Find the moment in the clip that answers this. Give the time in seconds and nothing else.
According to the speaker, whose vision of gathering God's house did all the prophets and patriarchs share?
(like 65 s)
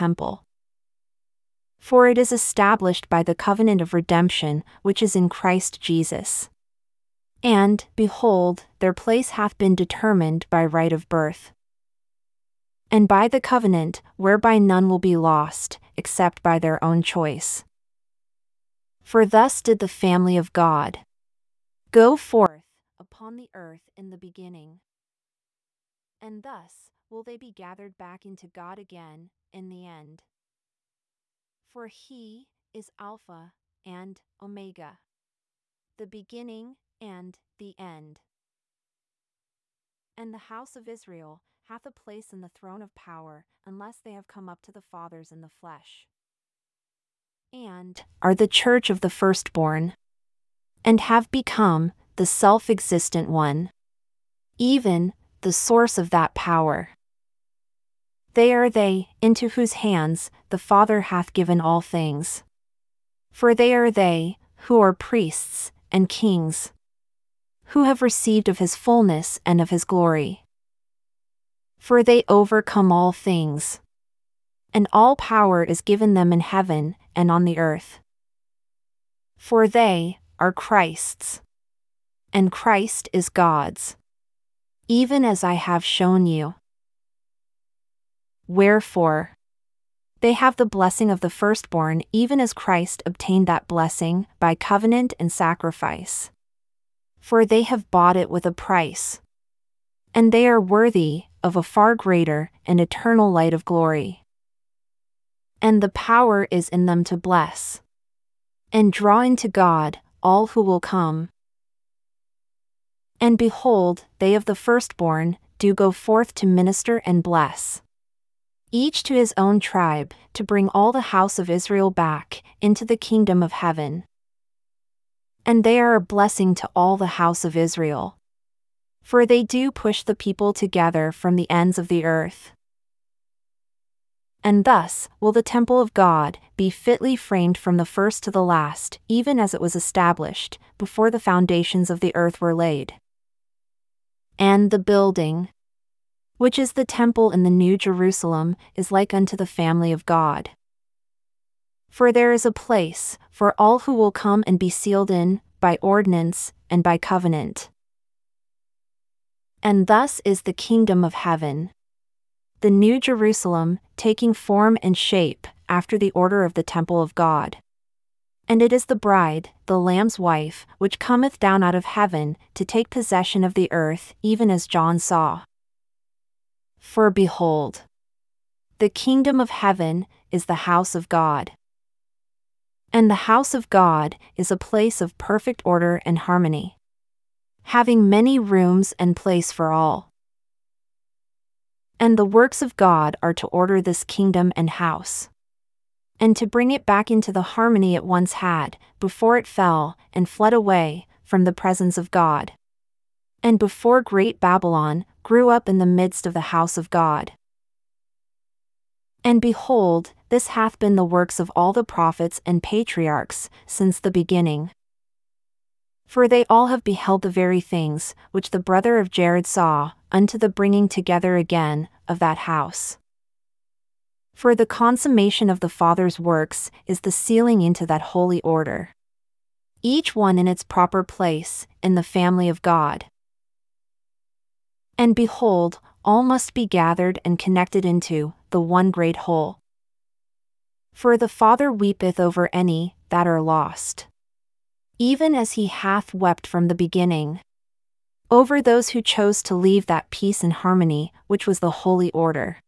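218 s.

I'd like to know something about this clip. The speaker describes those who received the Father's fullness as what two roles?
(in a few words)
priests and kings.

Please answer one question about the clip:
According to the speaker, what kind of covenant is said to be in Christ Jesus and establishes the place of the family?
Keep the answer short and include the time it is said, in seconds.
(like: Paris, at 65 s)
covenant of redemption, at 3 s.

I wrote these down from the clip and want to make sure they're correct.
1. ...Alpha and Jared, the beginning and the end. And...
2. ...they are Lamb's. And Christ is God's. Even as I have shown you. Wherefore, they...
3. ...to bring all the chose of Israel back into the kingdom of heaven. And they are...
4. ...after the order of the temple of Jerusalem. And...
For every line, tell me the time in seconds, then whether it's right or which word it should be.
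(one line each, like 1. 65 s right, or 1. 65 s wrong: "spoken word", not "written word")
1. 32 s wrong: "Omega", not "Jared"
2. 79 s wrong: "Christ", not "Lamb"
3. 120 s wrong: "house", not "chose"
4. 165 s wrong: "God", not "Jerusalem".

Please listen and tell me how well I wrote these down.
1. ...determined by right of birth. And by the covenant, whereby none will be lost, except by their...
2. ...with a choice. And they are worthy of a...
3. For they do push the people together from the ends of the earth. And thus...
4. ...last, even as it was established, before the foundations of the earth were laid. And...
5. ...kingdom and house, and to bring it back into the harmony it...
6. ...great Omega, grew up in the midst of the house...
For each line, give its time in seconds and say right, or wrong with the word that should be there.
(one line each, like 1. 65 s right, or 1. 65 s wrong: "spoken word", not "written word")
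1. 9 s right
2. 98 s wrong: "price", not "choice"
3. 129 s right
4. 138 s right
5. 194 s right
6. 204 s wrong: "Babylon", not "Omega".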